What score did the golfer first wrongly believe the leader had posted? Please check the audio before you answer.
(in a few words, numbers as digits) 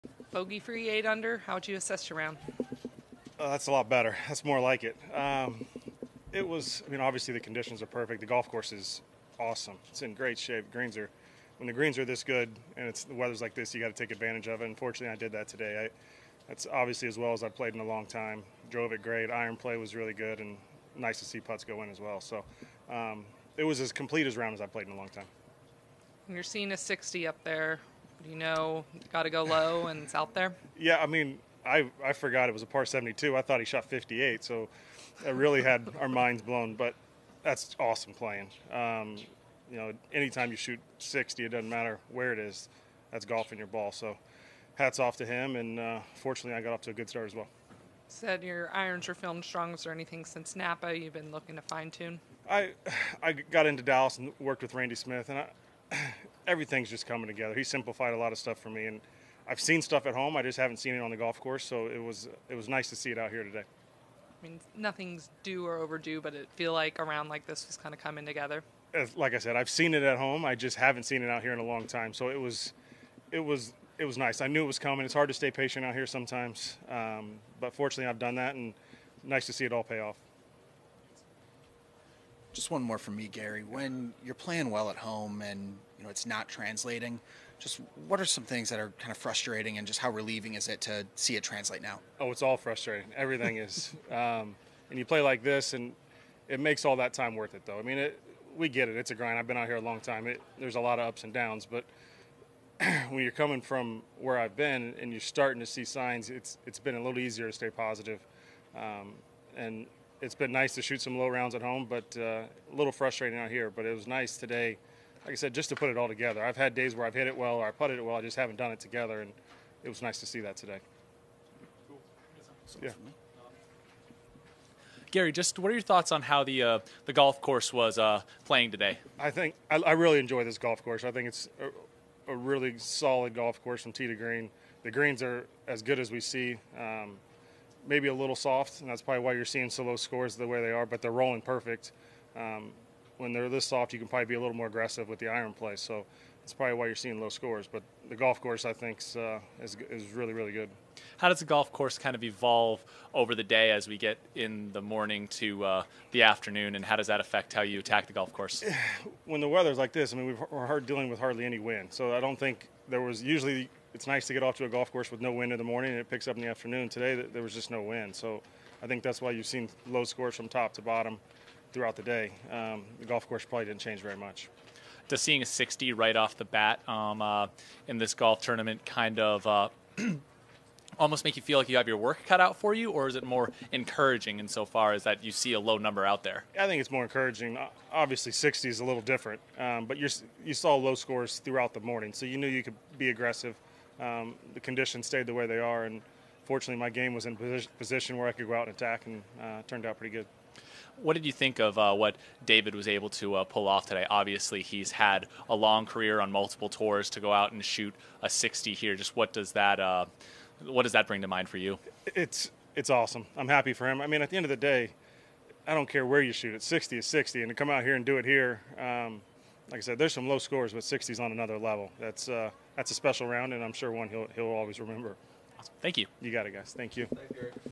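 58.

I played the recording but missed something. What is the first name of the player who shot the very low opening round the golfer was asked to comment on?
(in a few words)
David.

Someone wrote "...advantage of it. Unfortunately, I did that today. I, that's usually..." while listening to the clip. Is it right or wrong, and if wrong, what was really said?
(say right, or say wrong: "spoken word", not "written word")
wrong: "obviously", not "usually".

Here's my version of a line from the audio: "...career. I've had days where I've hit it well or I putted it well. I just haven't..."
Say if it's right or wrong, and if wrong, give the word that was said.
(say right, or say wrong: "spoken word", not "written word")
wrong: "together", not "career".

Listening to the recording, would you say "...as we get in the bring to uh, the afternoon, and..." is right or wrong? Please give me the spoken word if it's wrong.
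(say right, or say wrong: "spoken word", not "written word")
wrong: "morning", not "bring".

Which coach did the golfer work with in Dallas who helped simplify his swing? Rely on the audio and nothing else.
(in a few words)
Randy Smith.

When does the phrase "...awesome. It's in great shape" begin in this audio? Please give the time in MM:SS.
00:09.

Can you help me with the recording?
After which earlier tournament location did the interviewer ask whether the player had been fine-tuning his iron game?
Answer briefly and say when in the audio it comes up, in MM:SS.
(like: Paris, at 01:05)
Napa, at 00:50.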